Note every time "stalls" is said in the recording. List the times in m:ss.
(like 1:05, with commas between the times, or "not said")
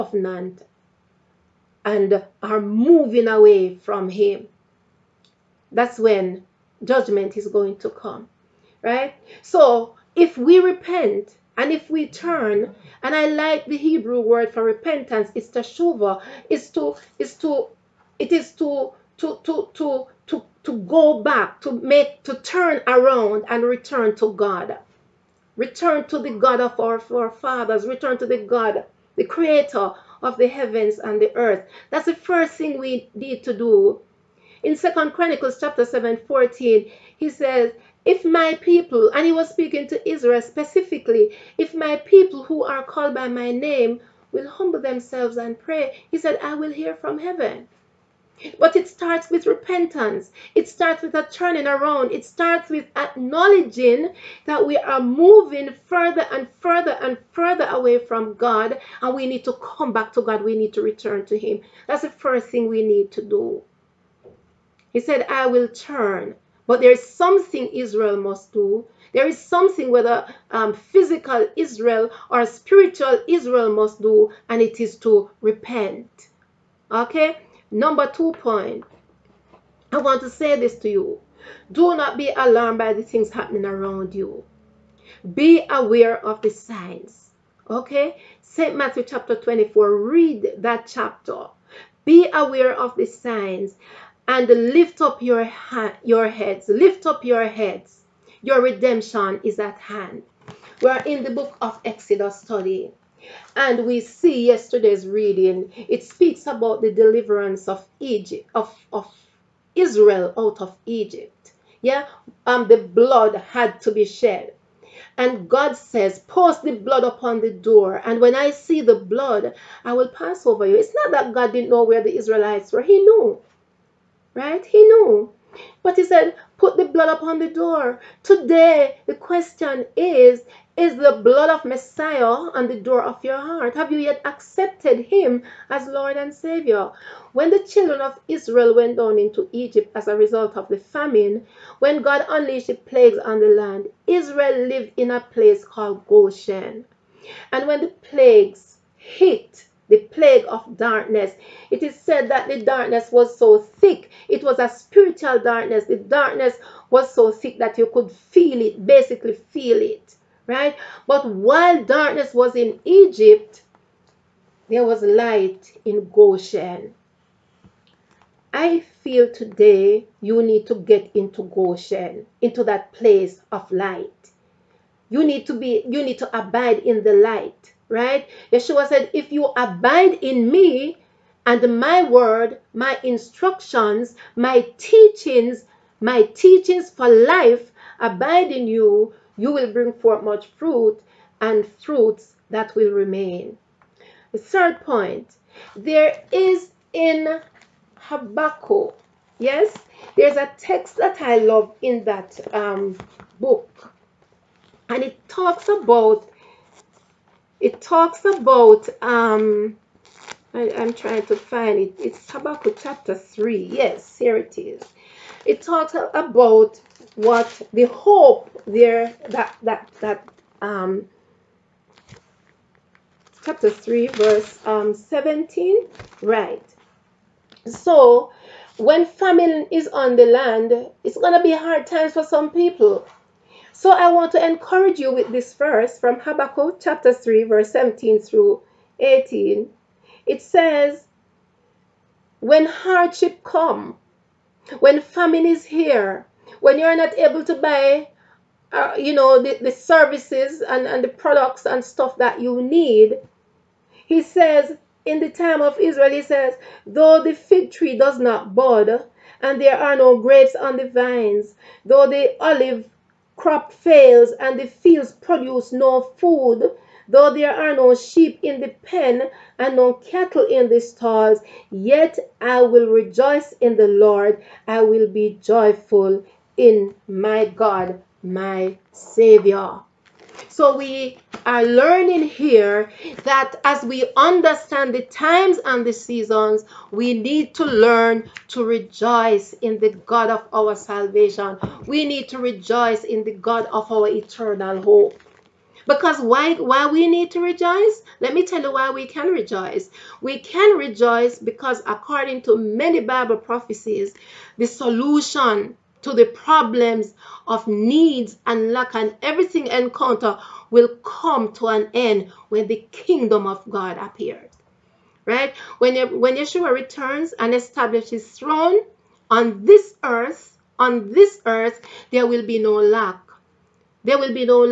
4:30.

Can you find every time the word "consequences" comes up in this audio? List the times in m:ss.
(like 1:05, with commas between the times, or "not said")
not said.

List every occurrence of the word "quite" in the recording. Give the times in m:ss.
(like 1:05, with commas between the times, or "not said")
not said.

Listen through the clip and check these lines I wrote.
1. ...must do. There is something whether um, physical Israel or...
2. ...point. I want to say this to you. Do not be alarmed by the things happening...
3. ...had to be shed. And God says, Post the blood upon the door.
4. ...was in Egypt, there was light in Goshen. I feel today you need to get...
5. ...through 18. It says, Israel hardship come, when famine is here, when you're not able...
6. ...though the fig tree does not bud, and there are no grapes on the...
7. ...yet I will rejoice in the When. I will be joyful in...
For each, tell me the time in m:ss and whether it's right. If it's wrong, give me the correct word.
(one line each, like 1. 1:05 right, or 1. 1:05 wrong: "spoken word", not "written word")
1. 1:08 right
2. 1:18 right
3. 1:53 right
4. 2:42 right
5. 3:58 wrong: "When", not "Israel"
6. 4:16 right
7. 4:31 wrong: "Lord", not "When".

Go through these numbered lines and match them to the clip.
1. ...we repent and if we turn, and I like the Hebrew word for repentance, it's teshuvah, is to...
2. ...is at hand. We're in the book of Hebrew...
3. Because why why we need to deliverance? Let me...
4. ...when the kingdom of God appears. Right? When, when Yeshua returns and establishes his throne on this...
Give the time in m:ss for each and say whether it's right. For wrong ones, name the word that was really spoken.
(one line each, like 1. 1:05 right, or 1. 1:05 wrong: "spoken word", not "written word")
1. 0:10 right
2. 1:39 wrong: "Exodus", not "Hebrew"
3. 4:55 wrong: "rejoice", not "deliverance"
4. 5:12 right.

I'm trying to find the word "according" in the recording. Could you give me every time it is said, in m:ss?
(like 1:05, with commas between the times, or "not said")
5:01.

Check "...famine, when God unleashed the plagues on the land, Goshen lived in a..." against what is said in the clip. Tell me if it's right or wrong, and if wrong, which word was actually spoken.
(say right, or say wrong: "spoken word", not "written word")
wrong: "Israel", not "Goshen".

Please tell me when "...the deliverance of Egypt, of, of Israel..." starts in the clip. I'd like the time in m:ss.
1:46.